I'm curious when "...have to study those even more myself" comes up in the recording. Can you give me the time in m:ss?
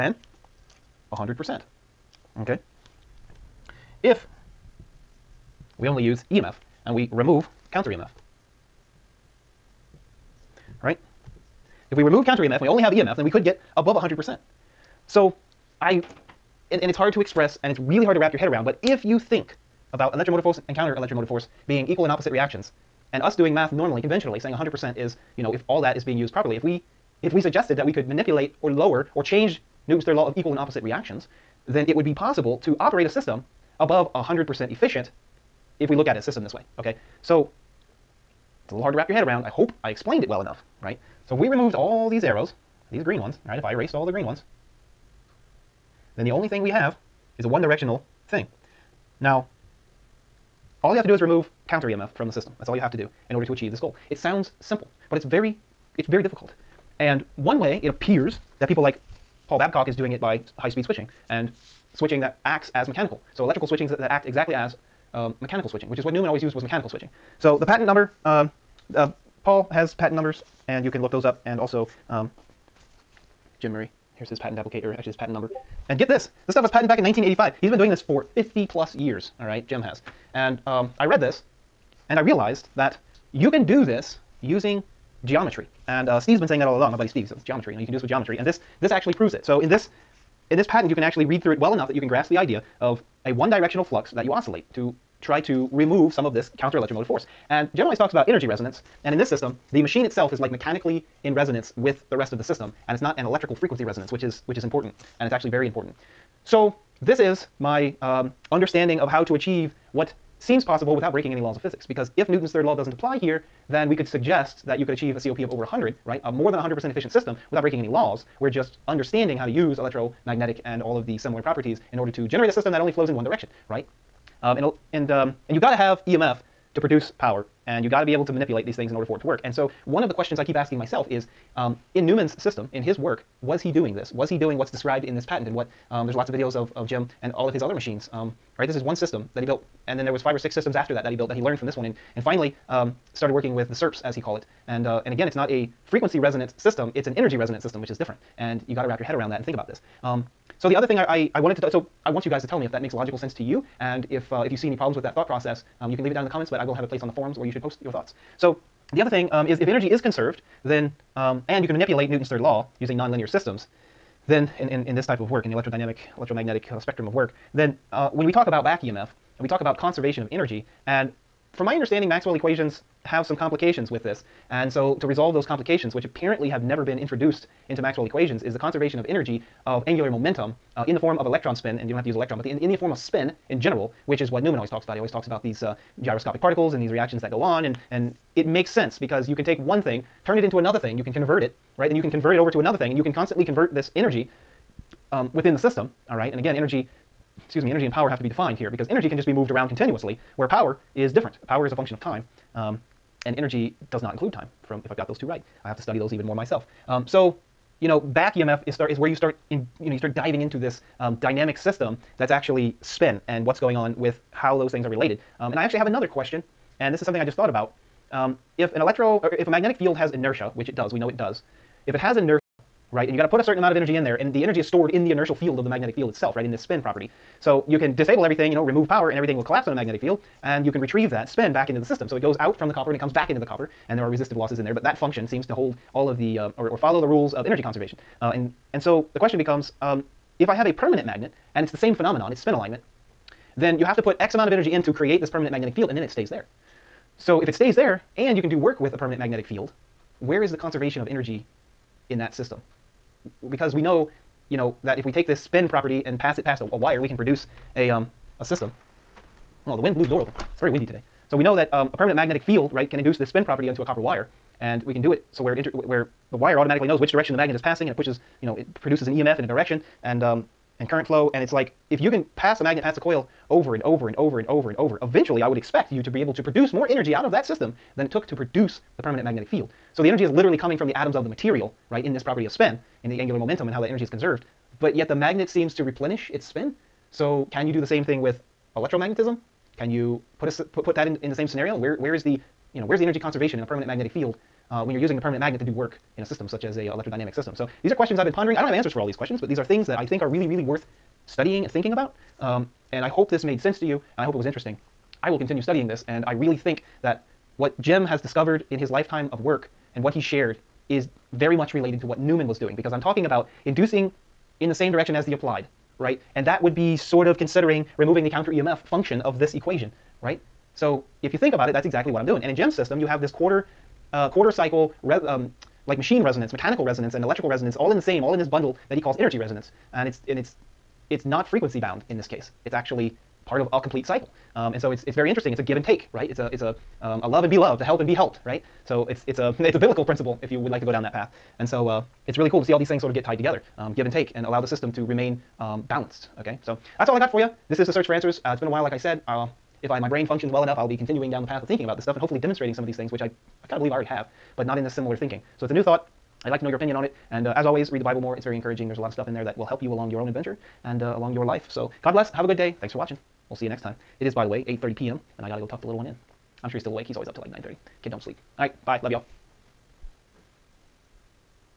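3:25.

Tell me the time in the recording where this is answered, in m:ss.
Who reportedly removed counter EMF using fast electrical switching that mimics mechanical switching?
0:59.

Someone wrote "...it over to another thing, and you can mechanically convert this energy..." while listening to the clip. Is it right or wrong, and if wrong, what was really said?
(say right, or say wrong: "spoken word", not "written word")
wrong: "constantly", not "mechanically".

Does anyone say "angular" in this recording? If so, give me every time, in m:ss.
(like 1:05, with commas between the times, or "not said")
2:59, 4:43.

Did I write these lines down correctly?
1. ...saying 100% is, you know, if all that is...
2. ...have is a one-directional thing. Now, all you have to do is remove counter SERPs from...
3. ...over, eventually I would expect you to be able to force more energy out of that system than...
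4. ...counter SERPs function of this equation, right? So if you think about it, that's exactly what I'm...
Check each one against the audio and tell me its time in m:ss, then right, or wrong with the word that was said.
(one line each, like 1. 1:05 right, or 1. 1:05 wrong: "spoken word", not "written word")
1. 0:24 right
2. 0:46 wrong: "EMF", not "SERPs"
3. 4:34 wrong: "produce", not "force"
4. 5:18 wrong: "EMF", not "SERPs".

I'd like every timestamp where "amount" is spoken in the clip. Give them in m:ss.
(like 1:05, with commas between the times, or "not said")
3:43, 4:04.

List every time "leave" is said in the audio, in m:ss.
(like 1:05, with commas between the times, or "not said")
2:36.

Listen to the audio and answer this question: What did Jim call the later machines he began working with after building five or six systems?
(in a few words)
SERPs.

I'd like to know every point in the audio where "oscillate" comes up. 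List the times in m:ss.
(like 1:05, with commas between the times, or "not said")
1:34.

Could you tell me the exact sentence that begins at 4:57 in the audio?
So these are questions I've been pondering.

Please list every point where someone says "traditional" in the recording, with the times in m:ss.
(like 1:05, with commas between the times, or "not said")
not said.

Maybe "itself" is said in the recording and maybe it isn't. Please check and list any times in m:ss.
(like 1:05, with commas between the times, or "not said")
1:40, 3:46.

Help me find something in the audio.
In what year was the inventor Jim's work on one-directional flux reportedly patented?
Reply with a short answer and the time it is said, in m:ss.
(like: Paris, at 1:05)
1985, at 1:17.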